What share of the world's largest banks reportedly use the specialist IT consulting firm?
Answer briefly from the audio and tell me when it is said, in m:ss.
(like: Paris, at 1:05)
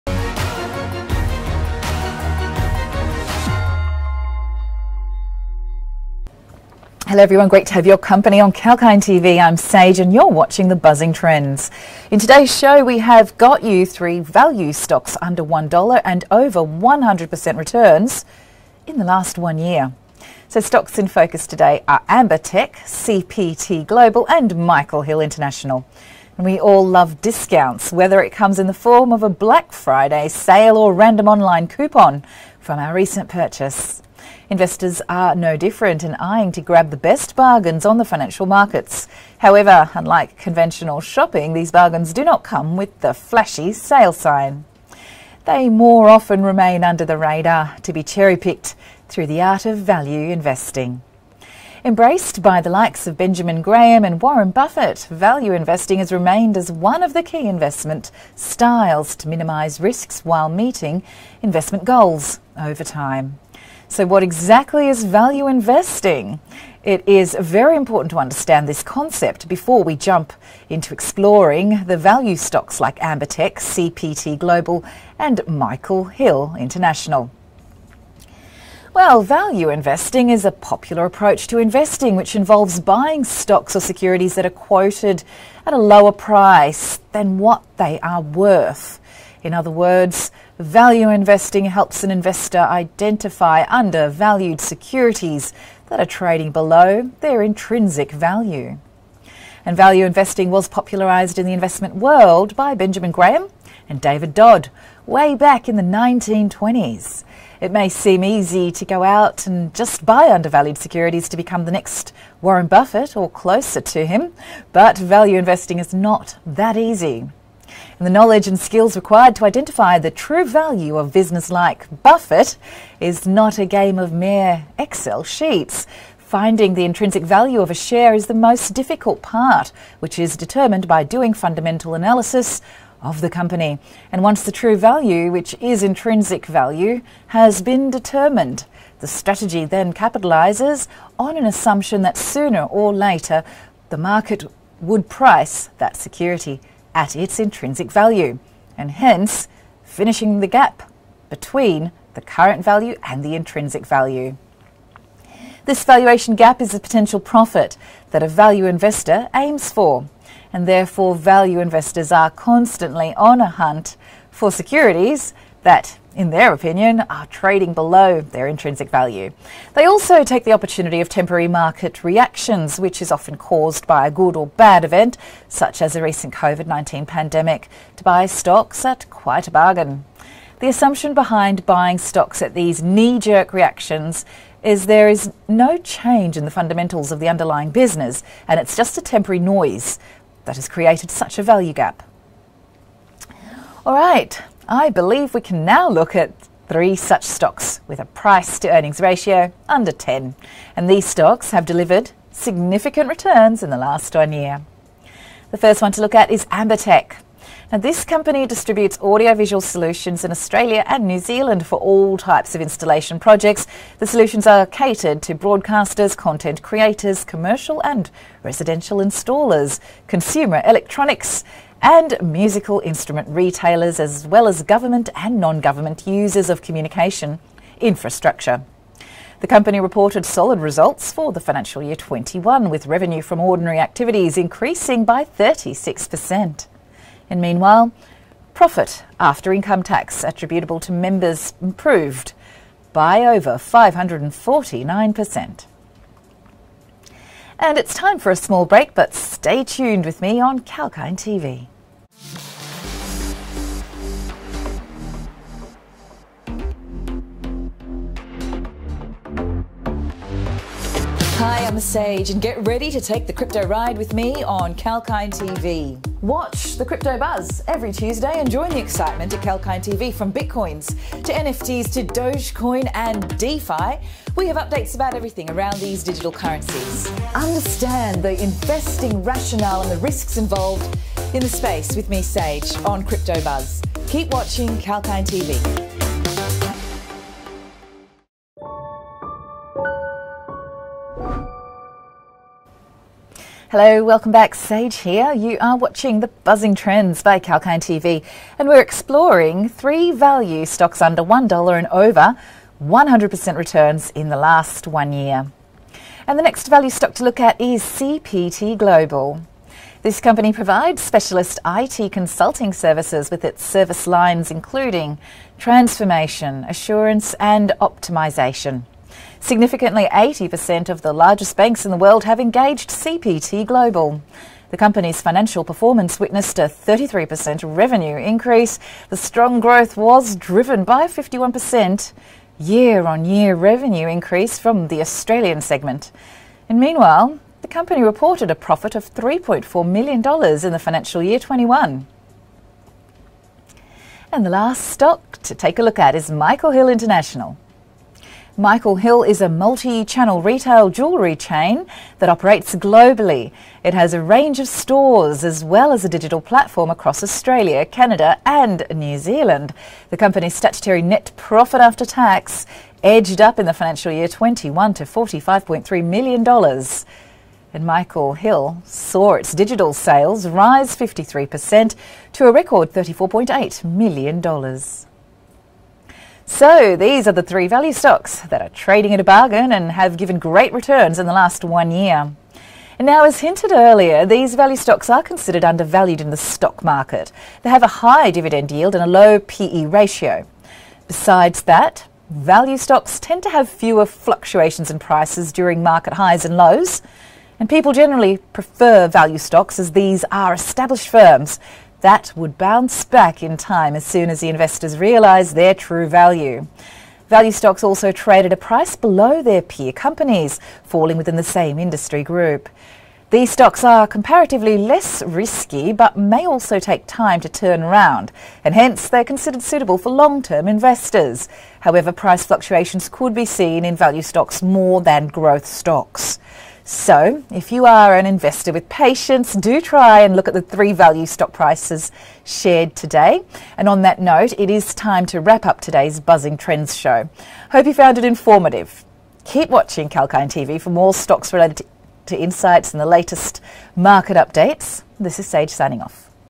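80%, at 5:20.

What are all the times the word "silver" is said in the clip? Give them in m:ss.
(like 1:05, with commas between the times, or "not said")
not said.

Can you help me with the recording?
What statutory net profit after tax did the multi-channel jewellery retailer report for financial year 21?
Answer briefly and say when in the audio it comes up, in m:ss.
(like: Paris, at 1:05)
$45.3 million, at 6:05.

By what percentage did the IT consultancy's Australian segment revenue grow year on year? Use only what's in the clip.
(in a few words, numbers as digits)
51%.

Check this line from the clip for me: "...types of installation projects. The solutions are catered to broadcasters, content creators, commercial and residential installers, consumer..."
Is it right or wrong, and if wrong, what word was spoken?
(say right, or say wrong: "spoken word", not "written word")
right.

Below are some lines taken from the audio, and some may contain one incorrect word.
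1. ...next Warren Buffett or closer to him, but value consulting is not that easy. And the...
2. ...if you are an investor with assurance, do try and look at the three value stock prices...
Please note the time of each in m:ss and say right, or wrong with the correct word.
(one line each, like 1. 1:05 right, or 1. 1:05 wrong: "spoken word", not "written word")
1. 1:51 wrong: "investing", not "consulting"
2. 7:07 wrong: "patience", not "assurance".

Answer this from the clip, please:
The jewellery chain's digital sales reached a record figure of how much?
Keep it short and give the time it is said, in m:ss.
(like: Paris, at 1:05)
$34.8 million, at 6:12.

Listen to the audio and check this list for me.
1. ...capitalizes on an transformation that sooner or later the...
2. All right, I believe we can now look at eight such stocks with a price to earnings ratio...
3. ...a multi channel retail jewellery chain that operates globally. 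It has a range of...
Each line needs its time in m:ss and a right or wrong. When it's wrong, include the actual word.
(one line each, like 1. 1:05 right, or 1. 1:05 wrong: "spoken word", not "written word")
1. 2:19 wrong: "assumption", not "transformation"
2. 3:13 wrong: "three", not "eight"
3. 5:49 right.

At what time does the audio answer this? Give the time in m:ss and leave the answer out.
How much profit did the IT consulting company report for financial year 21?
5:39.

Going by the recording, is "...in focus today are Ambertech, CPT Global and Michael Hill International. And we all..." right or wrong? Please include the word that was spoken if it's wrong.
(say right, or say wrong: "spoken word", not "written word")
right.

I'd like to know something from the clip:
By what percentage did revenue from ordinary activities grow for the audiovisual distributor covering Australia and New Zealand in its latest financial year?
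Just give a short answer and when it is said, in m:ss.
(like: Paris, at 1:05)
36%, at 3:55.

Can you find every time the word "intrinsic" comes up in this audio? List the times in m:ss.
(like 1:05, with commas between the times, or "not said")
1:37, 2:06, 2:15, 2:27, 2:33, 2:48.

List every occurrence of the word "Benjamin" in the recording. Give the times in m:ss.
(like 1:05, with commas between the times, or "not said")
0:53, 1:42.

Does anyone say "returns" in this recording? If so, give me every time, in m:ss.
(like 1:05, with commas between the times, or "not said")
0:17, 3:23, 5:03, 6:20.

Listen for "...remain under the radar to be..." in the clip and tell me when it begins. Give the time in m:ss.
0:46.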